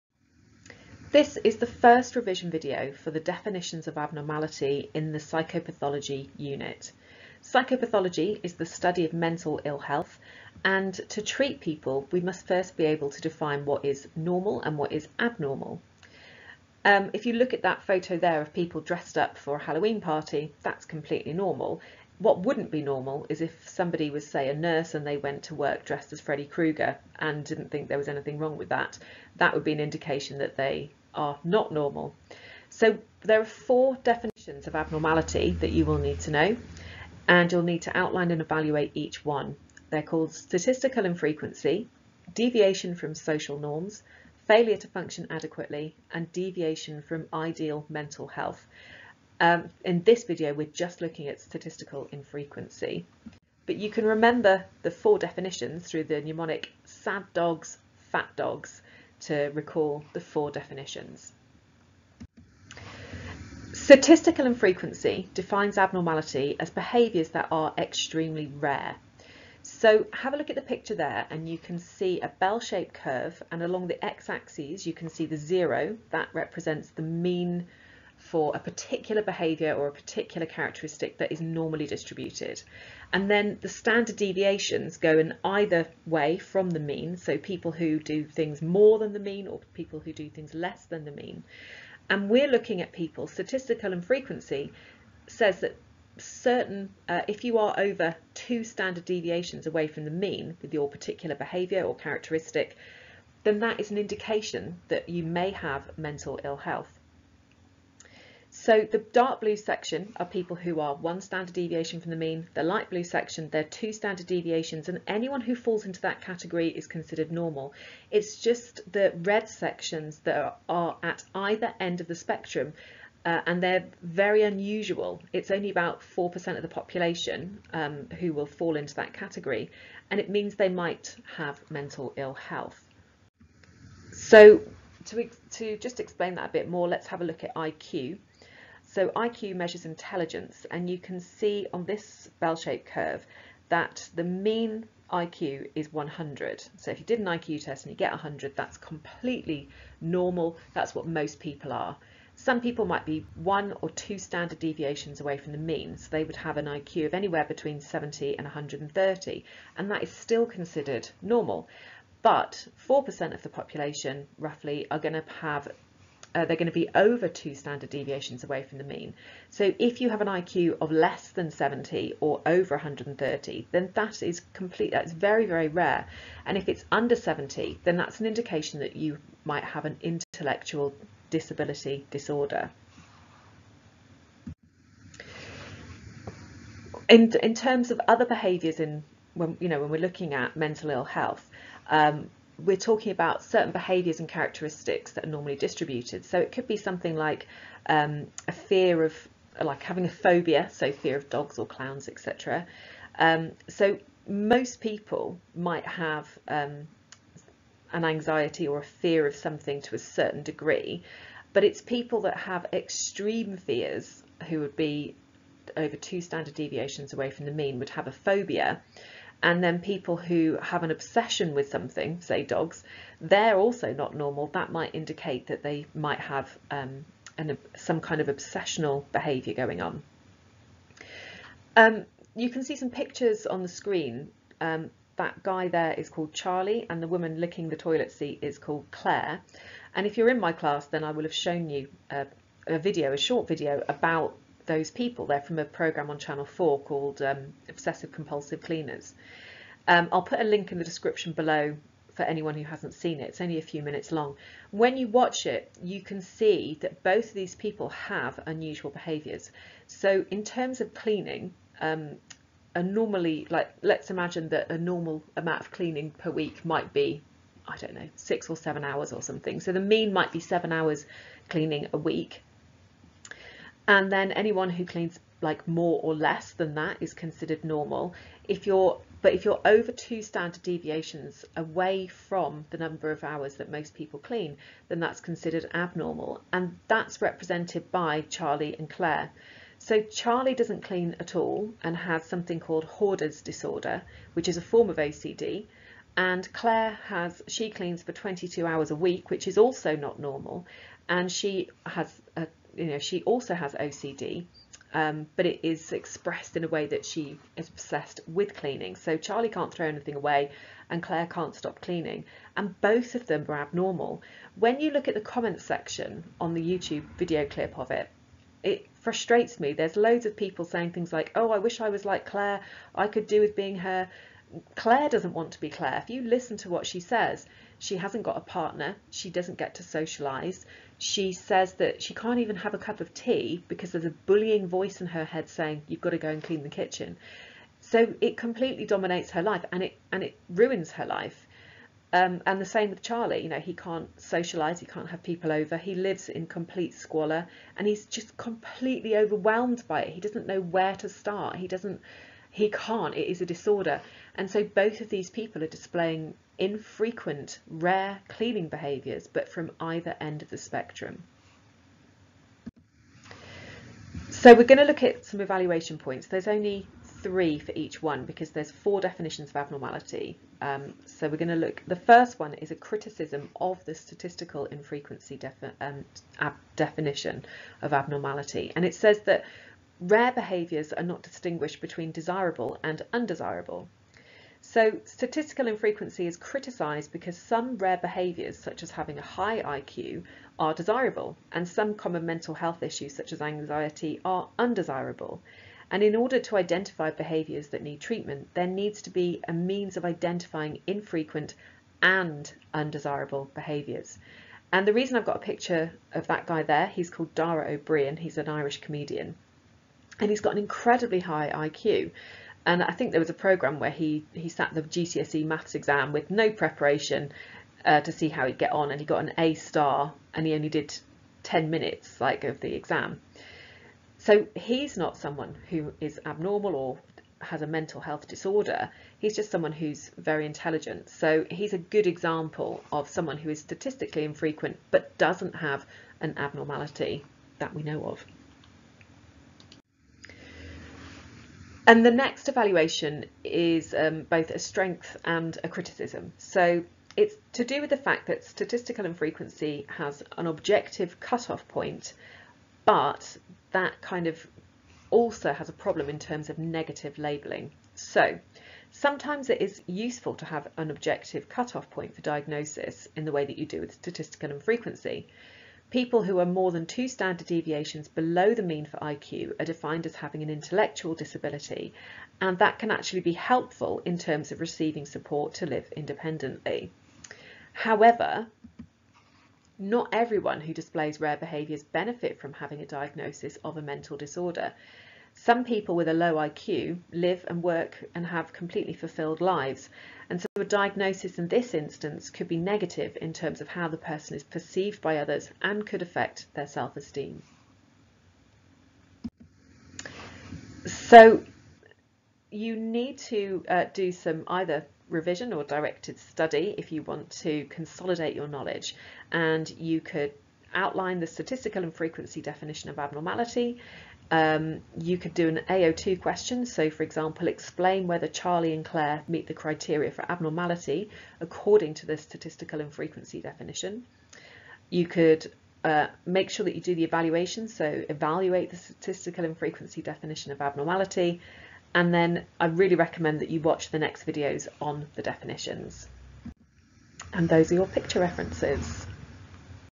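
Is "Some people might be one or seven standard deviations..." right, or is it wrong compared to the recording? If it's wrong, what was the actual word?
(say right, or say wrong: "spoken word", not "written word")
wrong: "two", not "seven".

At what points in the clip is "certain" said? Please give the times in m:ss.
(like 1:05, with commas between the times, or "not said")
1:36, 3:13, 3:29.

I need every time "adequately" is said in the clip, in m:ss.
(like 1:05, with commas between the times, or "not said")
0:45.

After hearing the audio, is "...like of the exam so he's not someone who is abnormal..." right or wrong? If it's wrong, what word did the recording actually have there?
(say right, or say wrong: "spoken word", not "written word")
right.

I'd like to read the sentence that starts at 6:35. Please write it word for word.
And in order to identify behaviours that need treatment, there needs to be a means of identifying infrequent and undesirable behaviours.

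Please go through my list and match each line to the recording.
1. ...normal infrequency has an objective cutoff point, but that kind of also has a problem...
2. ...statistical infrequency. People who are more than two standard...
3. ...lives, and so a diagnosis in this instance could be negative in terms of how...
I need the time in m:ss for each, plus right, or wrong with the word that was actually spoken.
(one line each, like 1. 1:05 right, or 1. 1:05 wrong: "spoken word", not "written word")
1. 7:28 wrong: "statistical", not "normal"
2. 7:43 right
3. 8:09 right.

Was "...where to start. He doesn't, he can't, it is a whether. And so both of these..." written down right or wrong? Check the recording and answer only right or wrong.
wrong.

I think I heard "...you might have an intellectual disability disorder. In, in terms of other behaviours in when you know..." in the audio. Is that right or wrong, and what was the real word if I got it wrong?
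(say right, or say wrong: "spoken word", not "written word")
right.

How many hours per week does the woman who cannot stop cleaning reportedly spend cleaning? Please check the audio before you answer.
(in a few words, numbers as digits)
22.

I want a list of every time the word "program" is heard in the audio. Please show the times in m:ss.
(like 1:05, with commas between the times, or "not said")
4:05, 6:53.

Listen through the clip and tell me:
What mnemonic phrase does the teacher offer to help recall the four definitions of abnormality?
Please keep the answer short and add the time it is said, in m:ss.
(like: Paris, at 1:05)
sad dogs, fat dogs, at 0:56.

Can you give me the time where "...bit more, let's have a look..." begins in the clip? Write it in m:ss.
2:16.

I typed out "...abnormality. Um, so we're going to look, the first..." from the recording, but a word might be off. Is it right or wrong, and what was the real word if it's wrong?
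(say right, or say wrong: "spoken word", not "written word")
right.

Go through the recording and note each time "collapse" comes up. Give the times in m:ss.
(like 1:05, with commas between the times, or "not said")
not said.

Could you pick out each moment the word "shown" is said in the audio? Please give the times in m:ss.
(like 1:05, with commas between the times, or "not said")
4:01.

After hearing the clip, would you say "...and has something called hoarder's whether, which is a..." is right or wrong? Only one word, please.
wrong.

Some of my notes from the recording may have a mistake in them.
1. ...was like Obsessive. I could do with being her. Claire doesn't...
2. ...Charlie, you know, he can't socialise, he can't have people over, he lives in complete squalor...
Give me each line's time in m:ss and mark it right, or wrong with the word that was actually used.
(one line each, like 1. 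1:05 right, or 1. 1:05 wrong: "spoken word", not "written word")
1. 5:21 wrong: "Claire", not "Obsessive"
2. 5:43 right.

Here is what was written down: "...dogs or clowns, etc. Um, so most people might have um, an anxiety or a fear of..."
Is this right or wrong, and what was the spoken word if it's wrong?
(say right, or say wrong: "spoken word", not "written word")
right.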